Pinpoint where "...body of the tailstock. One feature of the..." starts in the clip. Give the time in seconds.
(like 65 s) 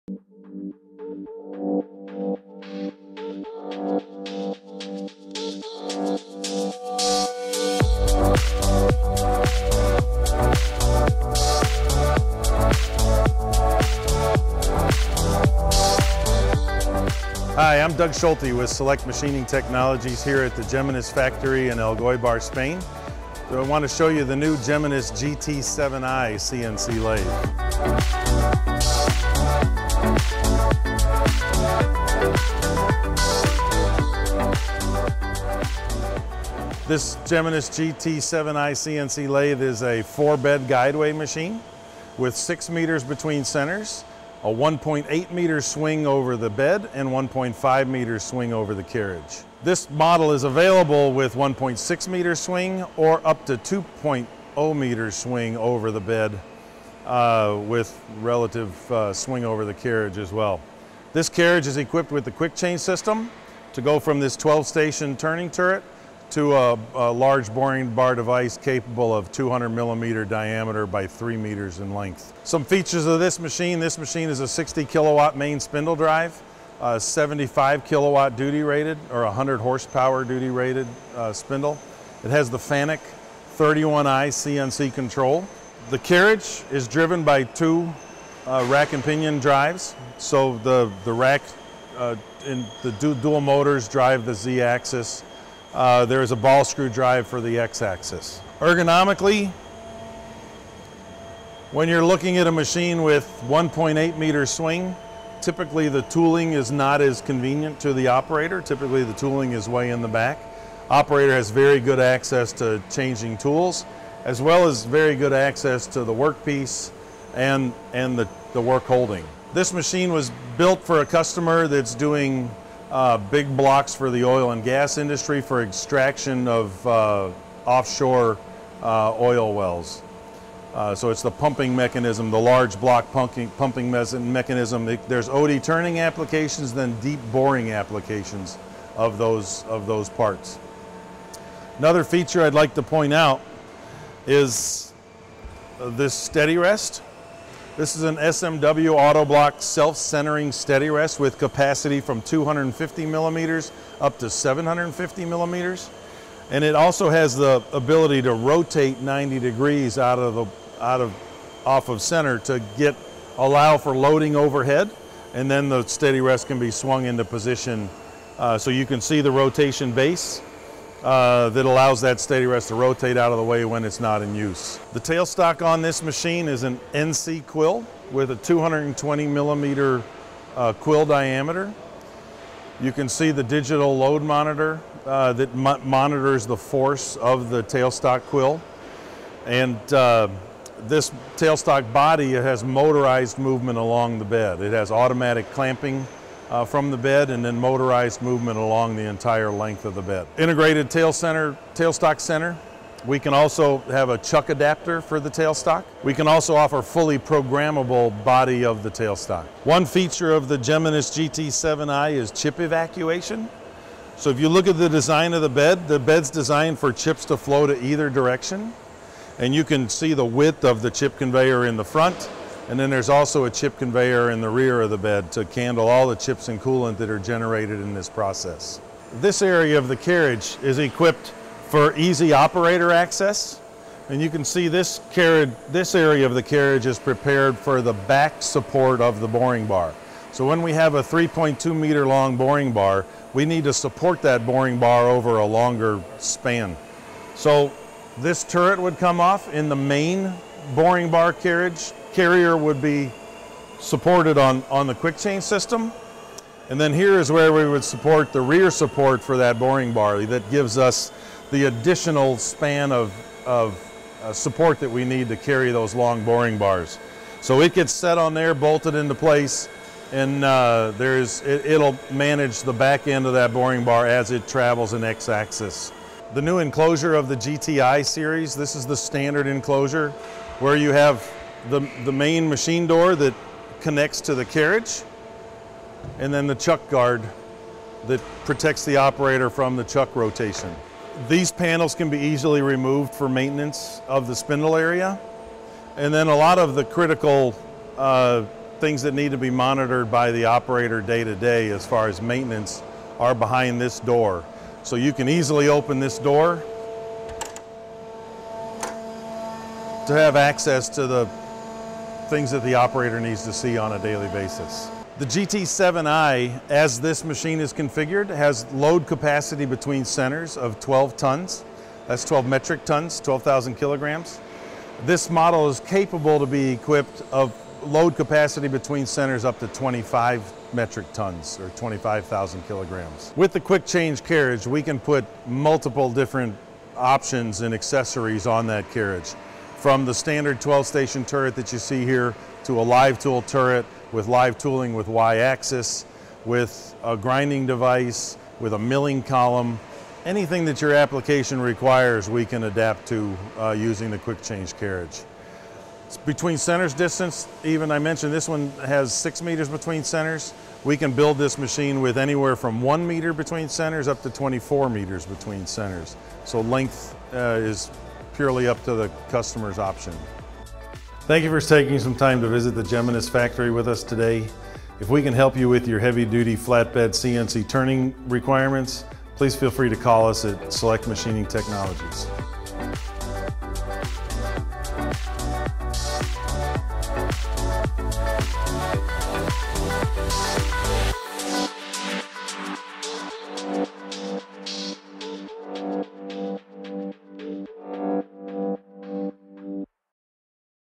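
208 s.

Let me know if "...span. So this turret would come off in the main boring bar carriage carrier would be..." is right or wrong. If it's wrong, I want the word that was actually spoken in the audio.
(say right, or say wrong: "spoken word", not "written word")
right.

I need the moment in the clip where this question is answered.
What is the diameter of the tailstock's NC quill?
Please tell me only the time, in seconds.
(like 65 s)
178 s.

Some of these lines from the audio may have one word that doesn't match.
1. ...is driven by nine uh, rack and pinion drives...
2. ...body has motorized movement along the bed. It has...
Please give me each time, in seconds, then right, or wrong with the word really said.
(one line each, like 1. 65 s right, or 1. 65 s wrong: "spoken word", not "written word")
1. 86 s wrong: "two", not "nine"
2. 191 s right.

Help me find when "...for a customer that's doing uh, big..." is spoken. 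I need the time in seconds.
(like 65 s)
120 s.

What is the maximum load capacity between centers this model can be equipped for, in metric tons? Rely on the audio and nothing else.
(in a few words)
25 metric tons.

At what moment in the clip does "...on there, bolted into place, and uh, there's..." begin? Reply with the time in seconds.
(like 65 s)
268 s.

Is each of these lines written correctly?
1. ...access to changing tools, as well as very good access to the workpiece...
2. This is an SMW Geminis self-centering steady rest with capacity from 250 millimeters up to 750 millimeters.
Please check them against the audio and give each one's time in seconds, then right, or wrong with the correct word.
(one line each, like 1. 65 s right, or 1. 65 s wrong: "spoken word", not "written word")
1. 112 s right
2. 147 s wrong: "Autoblok", not "Geminis".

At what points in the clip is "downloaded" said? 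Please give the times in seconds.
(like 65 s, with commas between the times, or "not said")
not said.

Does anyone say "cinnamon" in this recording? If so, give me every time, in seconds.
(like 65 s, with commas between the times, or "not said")
not said.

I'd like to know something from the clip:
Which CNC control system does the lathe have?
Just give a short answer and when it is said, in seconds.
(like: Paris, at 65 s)
Fanuc 31i, at 82 s.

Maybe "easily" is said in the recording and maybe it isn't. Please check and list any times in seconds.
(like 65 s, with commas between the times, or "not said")
292 s, 305 s.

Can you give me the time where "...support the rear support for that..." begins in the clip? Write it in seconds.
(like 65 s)
257 s.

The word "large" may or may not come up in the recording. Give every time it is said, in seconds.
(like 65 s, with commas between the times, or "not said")
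67 s, 132 s.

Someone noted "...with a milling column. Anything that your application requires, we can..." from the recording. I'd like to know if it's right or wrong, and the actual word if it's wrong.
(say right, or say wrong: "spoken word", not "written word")
right.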